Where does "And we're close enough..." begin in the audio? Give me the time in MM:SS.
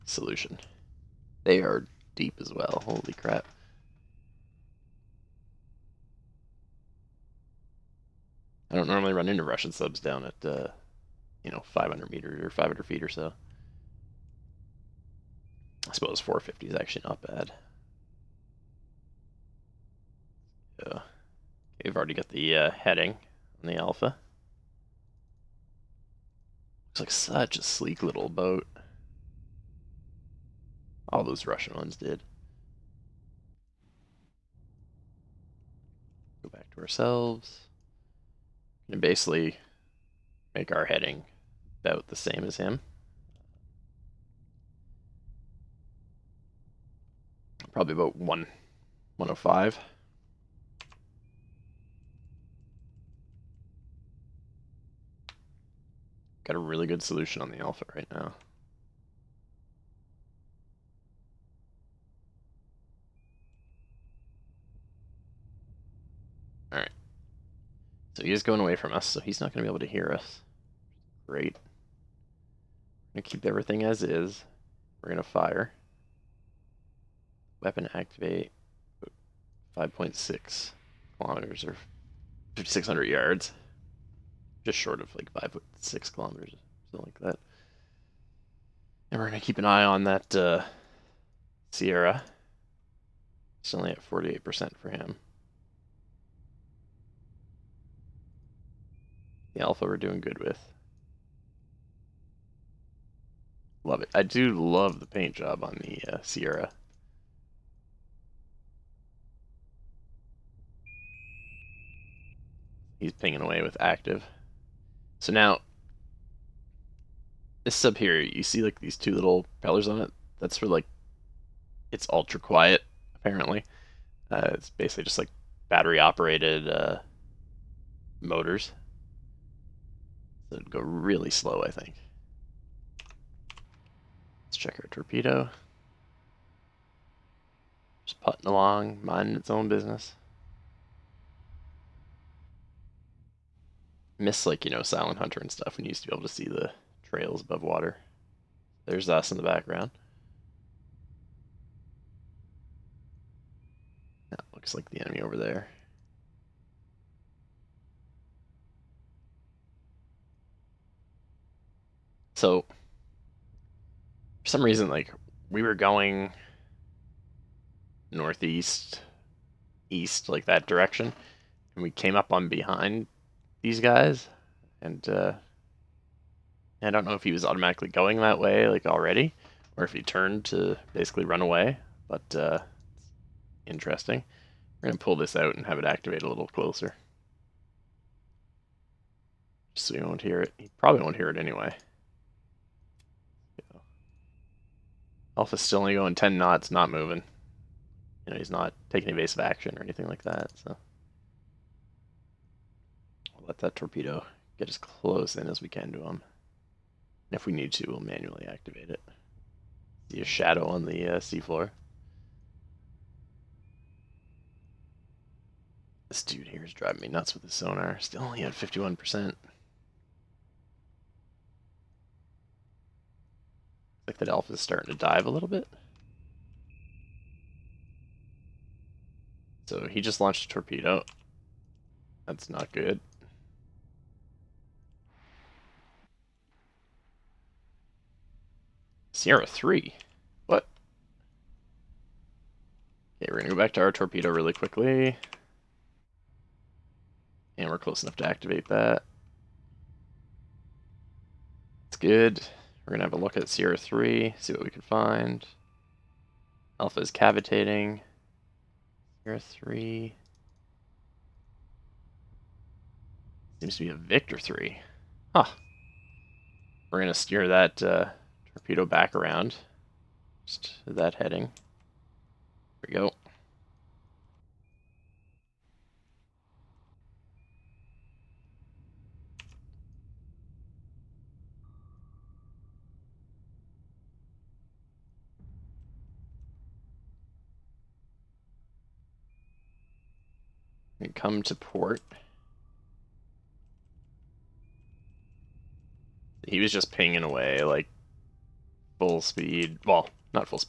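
04:07.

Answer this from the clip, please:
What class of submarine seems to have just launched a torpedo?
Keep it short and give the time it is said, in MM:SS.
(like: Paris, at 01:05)
Victor 3, at 04:23.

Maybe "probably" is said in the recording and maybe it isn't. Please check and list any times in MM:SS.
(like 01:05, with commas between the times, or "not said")
00:47, 03:10.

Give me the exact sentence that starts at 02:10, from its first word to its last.
So it'd go really slow, I think.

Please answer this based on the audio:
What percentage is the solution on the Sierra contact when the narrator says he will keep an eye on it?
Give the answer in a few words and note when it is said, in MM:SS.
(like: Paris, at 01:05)
48%, at 01:34.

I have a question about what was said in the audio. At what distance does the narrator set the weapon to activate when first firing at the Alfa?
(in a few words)
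5,600 yards.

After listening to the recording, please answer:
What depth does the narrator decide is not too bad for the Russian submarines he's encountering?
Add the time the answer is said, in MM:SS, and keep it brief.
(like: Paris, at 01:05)
450, at 00:16.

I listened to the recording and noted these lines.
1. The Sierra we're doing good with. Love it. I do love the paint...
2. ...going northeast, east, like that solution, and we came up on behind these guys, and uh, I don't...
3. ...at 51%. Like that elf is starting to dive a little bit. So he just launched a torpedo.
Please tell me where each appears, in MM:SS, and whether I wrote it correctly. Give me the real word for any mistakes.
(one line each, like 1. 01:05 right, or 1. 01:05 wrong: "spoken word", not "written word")
1. 01:39 wrong: "Alfa", not "Sierra"
2. 02:45 wrong: "direction", not "solution"
3. 03:38 right.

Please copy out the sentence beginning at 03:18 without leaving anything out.
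You know, he's not taking evasive action or anything like that, so.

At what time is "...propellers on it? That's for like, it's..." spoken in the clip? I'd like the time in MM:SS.
01:59.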